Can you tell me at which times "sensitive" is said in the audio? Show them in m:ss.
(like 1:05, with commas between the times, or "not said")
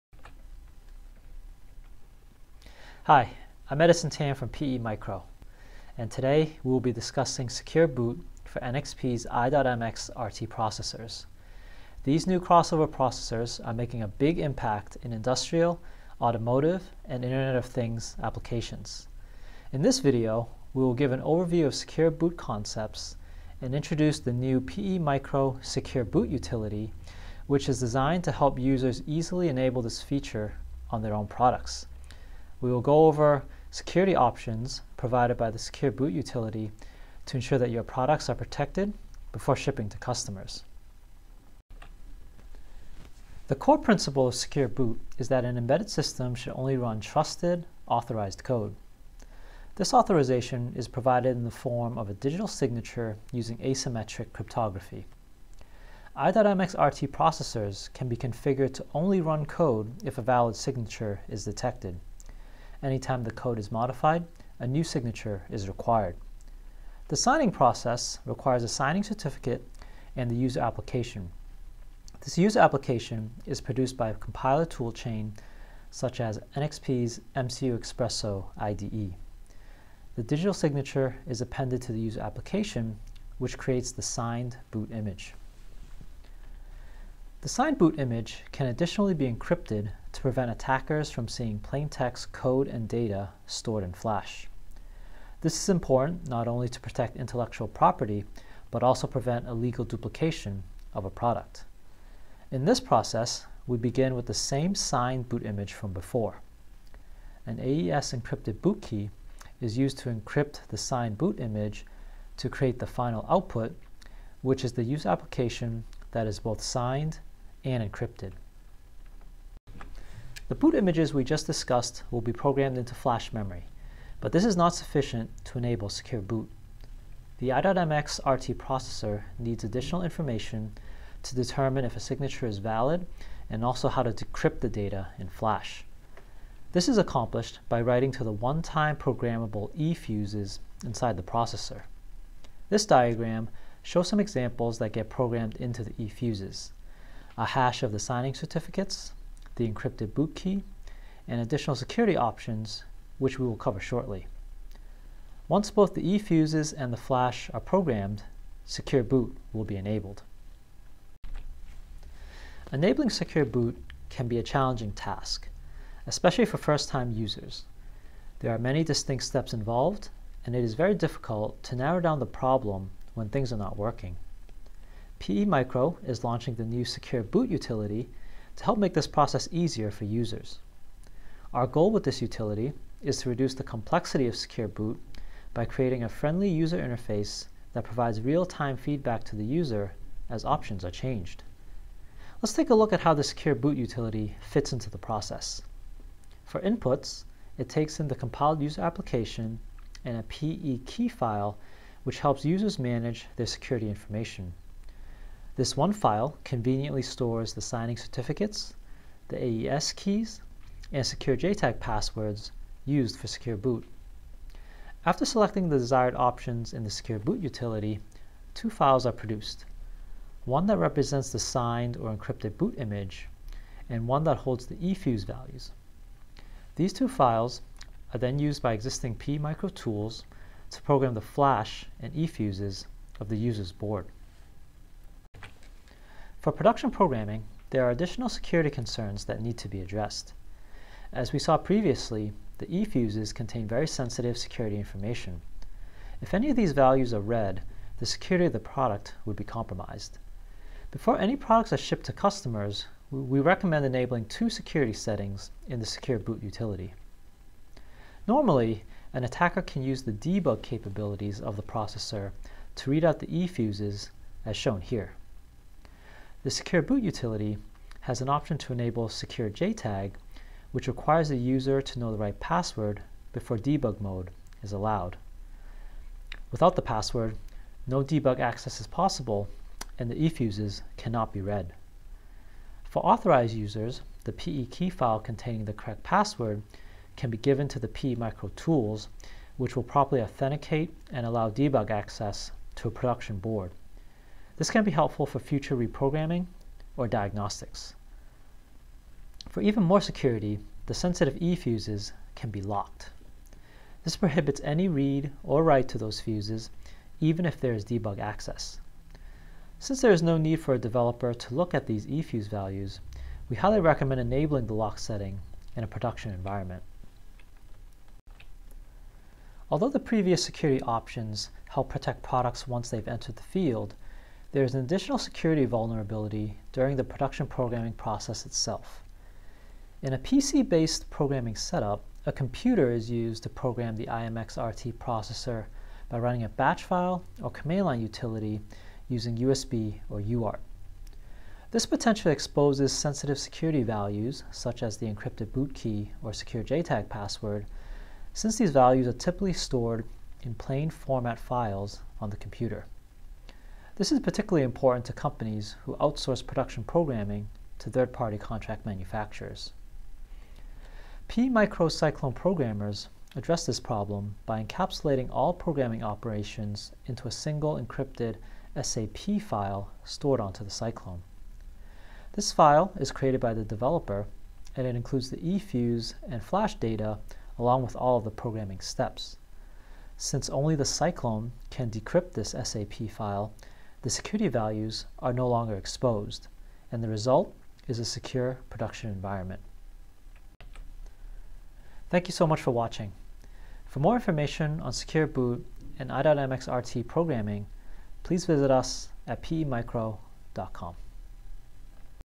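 4:03, 5:00, 5:42.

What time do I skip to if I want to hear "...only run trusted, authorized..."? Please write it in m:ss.
0:46.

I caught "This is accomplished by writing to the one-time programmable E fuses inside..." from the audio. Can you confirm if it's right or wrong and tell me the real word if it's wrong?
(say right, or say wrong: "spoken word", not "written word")
right.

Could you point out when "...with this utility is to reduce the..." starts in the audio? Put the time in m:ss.
3:01.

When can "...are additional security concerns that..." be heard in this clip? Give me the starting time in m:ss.
3:57.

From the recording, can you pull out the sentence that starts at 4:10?
Before any products are shipped to customers, we recommend enabling two security settings in the Secure Boot utility.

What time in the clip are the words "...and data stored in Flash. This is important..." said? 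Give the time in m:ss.
1:32.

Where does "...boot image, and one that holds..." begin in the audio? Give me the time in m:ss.
3:42.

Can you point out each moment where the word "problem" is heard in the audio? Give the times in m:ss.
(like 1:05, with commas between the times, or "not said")
2:52, 6:03.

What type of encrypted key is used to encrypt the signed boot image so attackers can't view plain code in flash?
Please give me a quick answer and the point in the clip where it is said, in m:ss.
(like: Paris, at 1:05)
AES encrypted boot key, at 1:47.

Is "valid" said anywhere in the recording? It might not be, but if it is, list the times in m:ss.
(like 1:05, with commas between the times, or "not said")
1:00, 2:12.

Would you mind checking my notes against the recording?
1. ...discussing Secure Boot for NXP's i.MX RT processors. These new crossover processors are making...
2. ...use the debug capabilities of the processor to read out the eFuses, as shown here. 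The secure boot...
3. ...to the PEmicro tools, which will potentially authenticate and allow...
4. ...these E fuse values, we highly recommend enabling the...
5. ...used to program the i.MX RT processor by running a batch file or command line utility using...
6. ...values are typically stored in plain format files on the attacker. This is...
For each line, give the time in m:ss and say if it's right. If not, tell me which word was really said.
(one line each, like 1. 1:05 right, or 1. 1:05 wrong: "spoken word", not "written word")
1. 0:06 right
2. 4:19 right
3. 4:47 wrong: "properly", not "potentially"
4. 5:11 right
5. 5:33 right
6. 5:48 wrong: "computer", not "attacker".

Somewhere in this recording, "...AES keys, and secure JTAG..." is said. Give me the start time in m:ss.
3:29.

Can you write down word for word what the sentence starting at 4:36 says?
Without the password, no debug access is possible and the eFuses cannot be read.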